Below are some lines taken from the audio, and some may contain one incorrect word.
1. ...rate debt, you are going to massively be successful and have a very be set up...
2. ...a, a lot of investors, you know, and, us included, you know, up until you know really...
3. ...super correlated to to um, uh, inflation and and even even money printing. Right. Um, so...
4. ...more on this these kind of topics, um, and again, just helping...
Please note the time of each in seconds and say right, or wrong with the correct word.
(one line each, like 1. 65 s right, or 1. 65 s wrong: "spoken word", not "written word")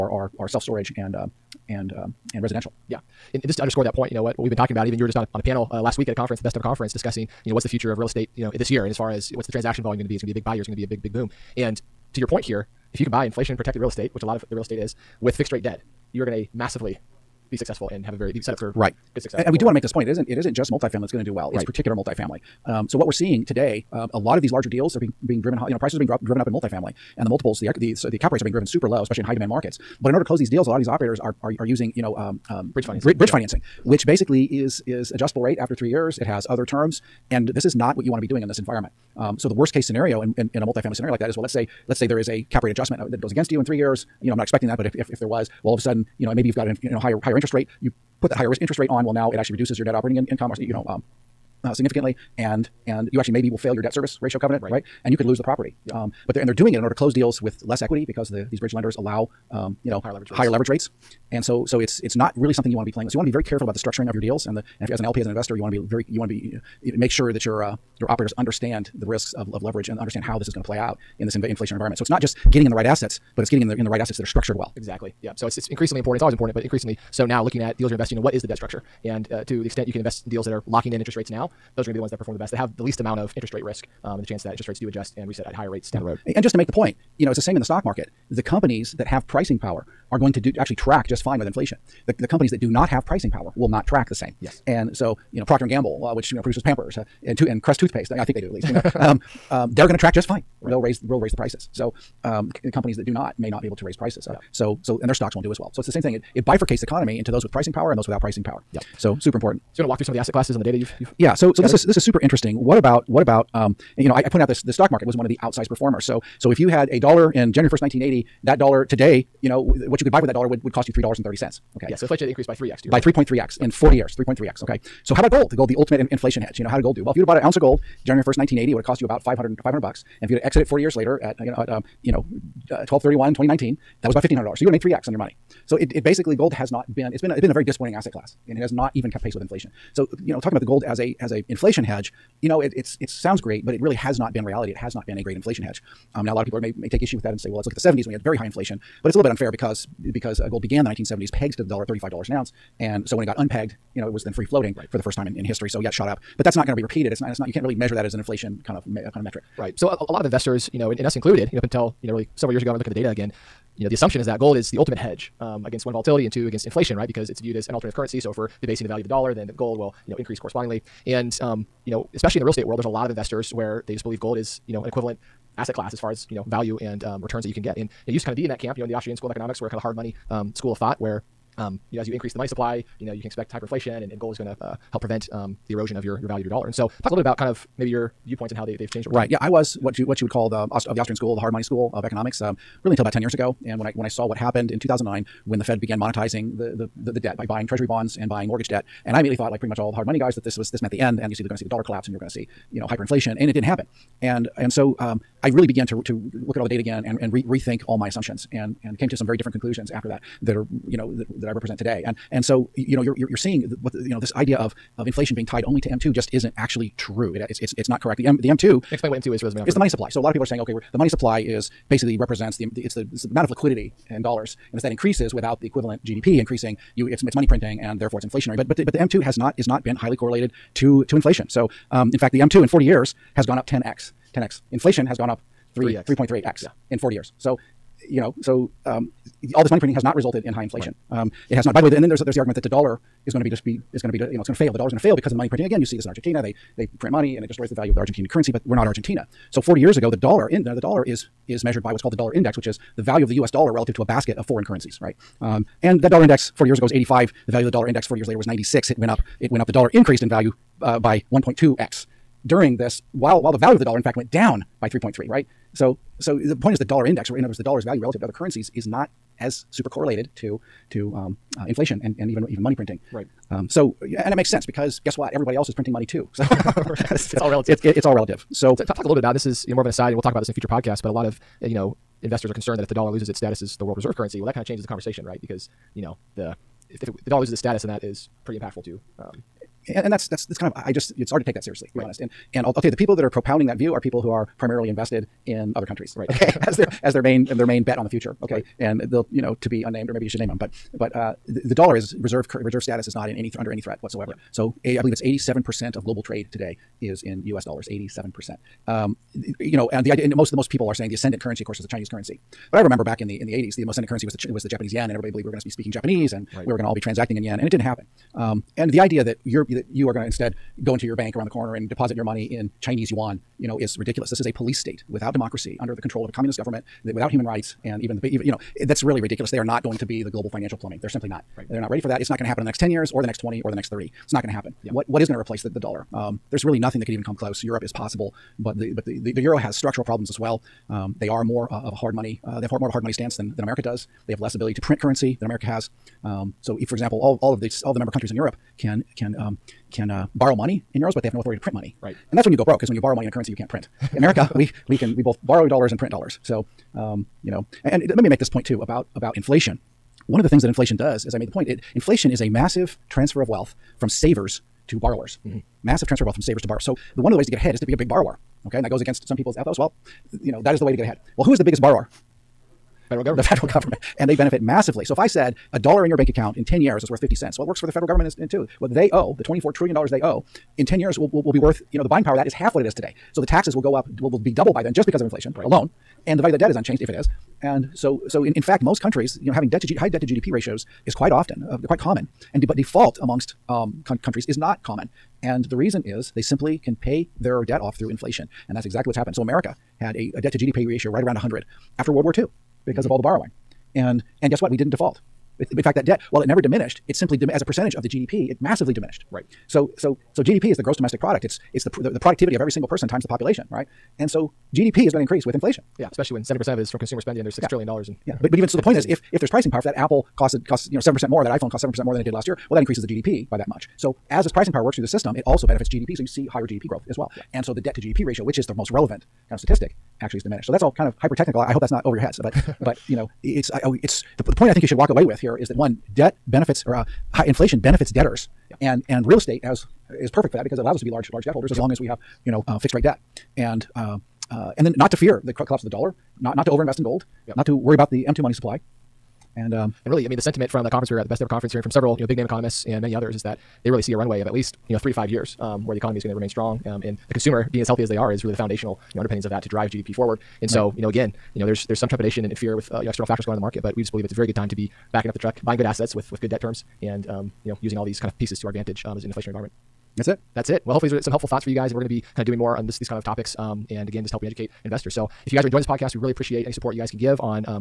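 1. 15 s right
2. 159 s right
3. 269 s right
4. 472 s right.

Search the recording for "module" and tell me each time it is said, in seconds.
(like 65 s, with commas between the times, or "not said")
not said.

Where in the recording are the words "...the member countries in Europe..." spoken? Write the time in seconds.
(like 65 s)
347 s.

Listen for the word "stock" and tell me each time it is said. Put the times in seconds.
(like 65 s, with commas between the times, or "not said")
87 s, 105 s, 114 s.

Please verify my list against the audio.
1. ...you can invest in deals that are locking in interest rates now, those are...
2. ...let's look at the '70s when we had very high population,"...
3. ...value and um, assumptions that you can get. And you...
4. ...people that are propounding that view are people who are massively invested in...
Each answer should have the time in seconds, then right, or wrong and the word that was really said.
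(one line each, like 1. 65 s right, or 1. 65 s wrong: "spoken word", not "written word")
1. 79 s right
2. 147 s wrong: "inflation", not "population"
3. 176 s wrong: "returns", not "assumptions"
4. 292 s wrong: "primarily", not "massively".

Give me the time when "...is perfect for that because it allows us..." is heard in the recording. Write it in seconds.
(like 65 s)
440 s.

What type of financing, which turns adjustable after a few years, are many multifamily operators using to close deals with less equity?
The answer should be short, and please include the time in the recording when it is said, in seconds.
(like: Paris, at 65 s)
bridge financing, at 32 s.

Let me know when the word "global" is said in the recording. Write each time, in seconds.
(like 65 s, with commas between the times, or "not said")
306 s, 330 s.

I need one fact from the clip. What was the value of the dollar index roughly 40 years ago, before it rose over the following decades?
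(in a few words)
85.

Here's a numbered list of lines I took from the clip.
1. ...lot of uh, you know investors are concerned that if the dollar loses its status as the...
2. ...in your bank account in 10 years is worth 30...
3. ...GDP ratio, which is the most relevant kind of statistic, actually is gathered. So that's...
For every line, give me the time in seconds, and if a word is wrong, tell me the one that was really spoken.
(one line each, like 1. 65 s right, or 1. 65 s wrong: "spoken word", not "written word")
1. 281 s right
2. 376 s wrong: "50", not "30"
3. 428 s wrong: "diminished", not "gathered".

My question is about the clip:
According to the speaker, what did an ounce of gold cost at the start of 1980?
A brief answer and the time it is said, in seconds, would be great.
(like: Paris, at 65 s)
about $500, at 129 s.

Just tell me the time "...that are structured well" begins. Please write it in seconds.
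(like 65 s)
74 s.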